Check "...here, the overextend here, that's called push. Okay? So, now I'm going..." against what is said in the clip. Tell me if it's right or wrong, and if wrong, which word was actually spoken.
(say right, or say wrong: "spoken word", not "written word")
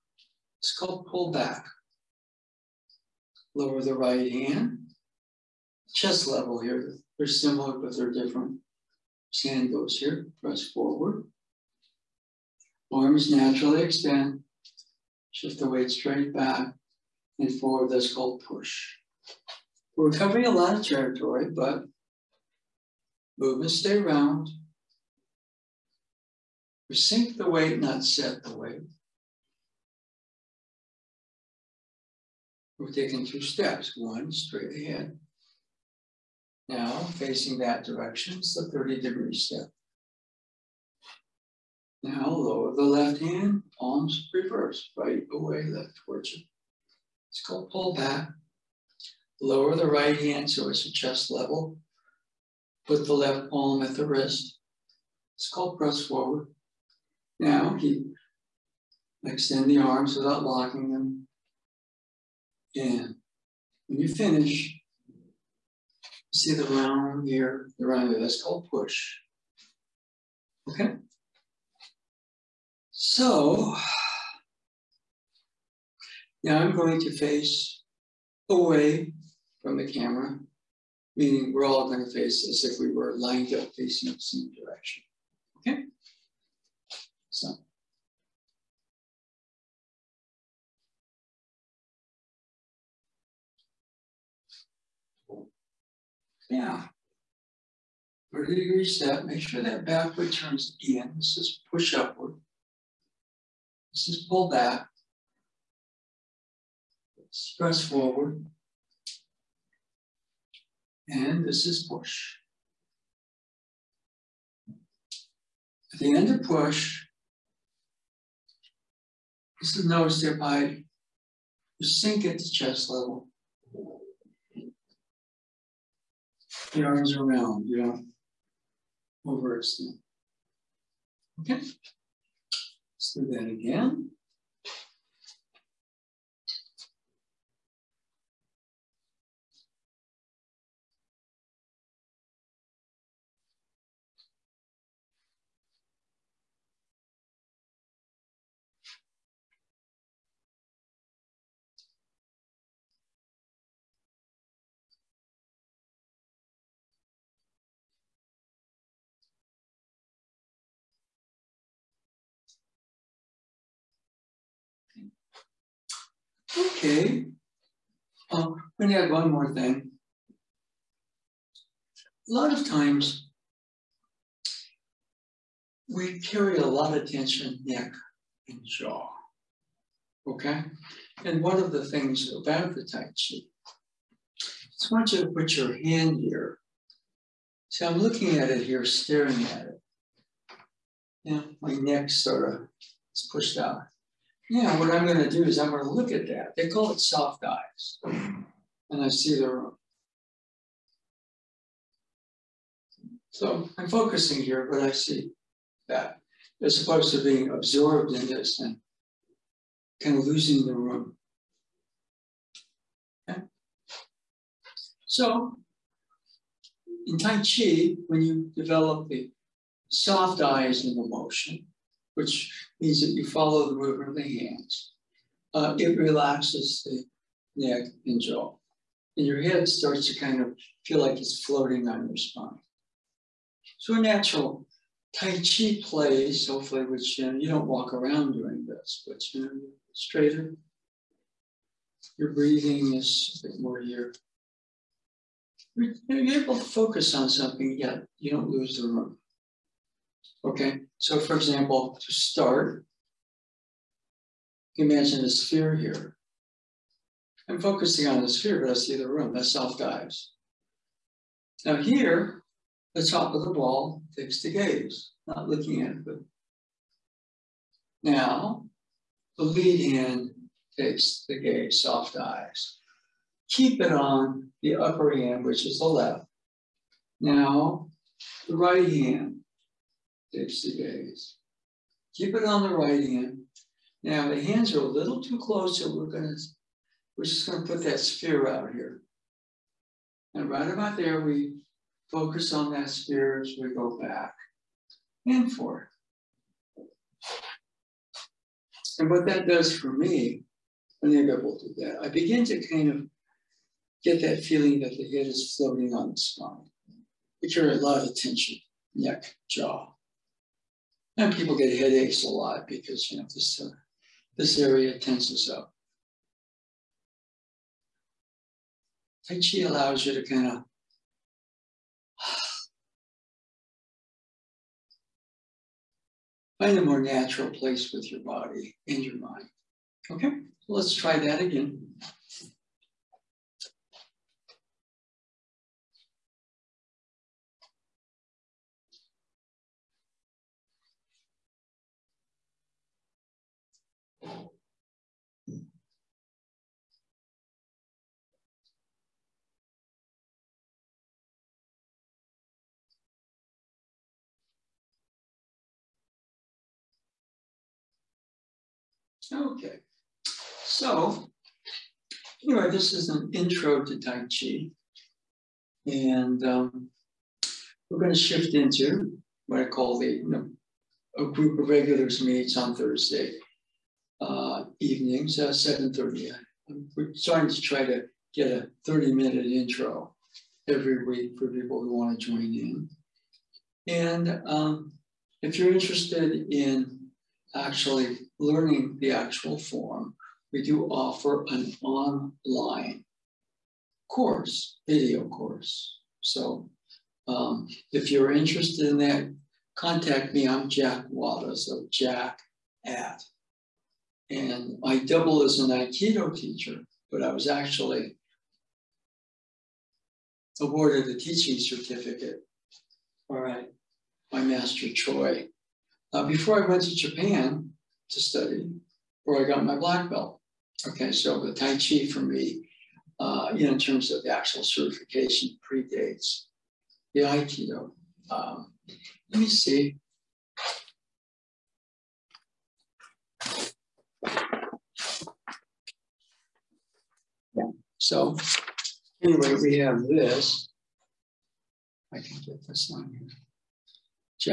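wrong: "round", not "overextend".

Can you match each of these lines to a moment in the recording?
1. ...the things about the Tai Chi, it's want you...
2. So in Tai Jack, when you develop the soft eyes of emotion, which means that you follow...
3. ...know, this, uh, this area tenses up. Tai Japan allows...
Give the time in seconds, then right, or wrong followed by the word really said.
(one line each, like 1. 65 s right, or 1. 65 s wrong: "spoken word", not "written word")
1. 181 s right
2. 215 s wrong: "Chi", not "Jack"
3. 313 s wrong: "Chi", not "Japan".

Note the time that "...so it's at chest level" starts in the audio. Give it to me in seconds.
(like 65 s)
50 s.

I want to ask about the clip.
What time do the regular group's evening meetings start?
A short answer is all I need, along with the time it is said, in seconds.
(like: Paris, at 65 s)
7:30, at 375 s.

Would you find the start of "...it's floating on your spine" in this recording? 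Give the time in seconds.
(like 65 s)
231 s.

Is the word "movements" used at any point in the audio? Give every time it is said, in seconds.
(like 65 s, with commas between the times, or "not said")
23 s, 223 s.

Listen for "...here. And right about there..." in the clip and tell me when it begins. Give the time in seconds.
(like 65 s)
288 s.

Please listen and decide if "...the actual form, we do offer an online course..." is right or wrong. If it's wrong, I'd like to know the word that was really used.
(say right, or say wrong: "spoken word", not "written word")
right.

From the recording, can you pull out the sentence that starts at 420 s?
Okay, so the Tai Chi for me, uh, in terms of the actual certification, predates the Aikido.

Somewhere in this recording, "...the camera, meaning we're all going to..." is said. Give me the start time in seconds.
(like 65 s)
79 s.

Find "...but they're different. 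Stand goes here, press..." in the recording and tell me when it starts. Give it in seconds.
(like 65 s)
7 s.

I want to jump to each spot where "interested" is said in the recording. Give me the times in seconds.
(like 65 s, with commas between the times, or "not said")
385 s, 398 s.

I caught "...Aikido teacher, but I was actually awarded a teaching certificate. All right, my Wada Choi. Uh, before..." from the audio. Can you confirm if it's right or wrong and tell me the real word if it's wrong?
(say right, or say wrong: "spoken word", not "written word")
wrong: "Master", not "Wada".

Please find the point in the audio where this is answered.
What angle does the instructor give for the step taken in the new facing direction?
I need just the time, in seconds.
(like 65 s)
38 s.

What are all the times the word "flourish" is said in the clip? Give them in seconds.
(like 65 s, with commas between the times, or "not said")
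not said.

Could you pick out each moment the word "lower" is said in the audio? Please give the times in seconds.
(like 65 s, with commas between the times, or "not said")
3 s, 42 s, 49 s.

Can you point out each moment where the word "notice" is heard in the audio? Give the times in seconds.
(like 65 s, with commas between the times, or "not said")
119 s.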